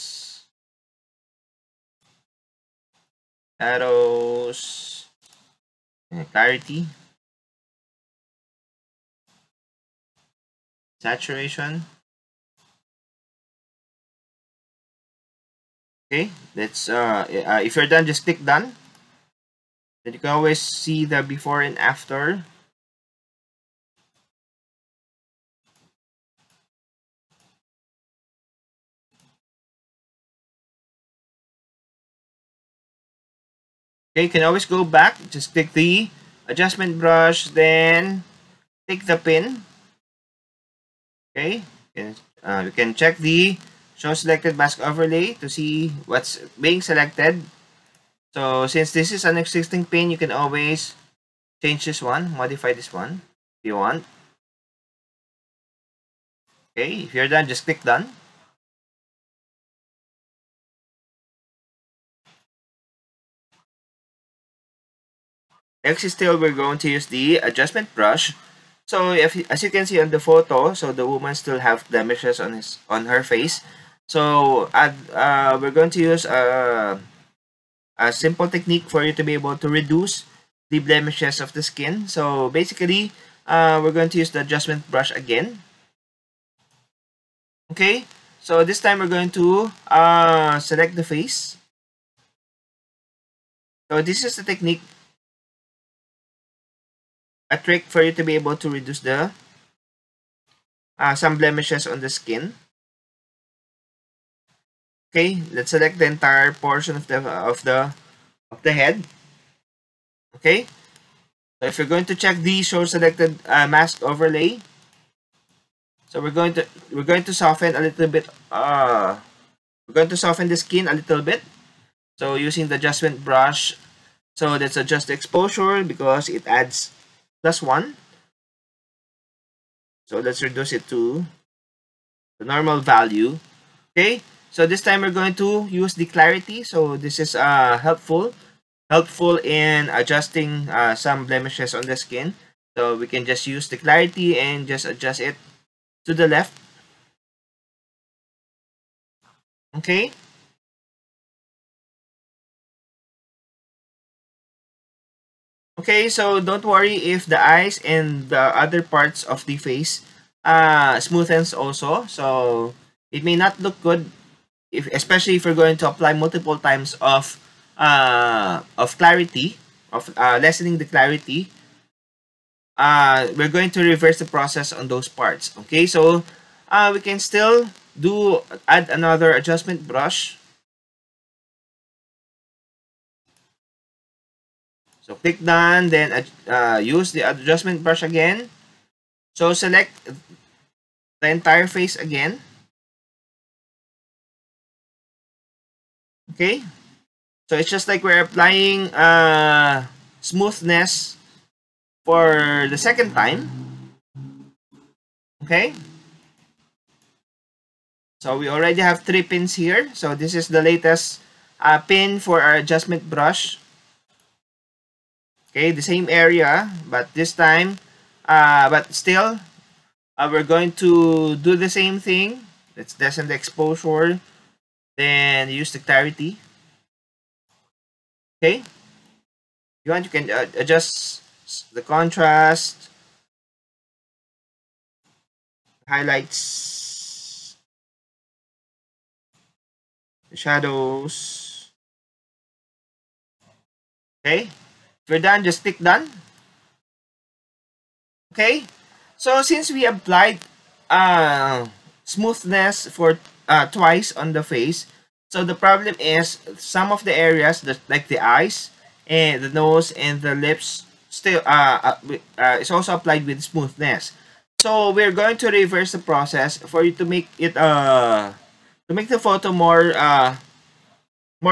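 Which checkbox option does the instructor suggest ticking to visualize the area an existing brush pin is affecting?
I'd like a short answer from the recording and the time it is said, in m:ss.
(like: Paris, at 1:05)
Show selected mask overlay, at 0:43.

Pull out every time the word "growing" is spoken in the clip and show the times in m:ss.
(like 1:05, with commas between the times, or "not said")
not said.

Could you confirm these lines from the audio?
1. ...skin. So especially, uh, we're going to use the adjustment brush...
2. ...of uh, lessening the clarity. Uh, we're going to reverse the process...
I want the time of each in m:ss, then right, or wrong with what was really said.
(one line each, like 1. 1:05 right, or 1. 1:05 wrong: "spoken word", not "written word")
1. 1:21 wrong: "basically", not "especially"
2. 2:49 right.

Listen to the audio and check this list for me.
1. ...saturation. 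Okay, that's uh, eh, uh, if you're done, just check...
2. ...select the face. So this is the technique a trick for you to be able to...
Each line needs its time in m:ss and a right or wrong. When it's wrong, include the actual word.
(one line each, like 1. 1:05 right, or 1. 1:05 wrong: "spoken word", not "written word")
1. 0:11 wrong: "click", not "check"
2. 1:30 right.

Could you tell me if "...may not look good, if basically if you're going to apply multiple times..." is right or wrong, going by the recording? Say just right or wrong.
wrong.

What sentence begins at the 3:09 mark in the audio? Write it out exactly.
So select the entire face again.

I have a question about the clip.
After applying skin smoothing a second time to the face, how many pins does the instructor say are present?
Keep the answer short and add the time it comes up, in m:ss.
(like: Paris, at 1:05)
3, at 3:29.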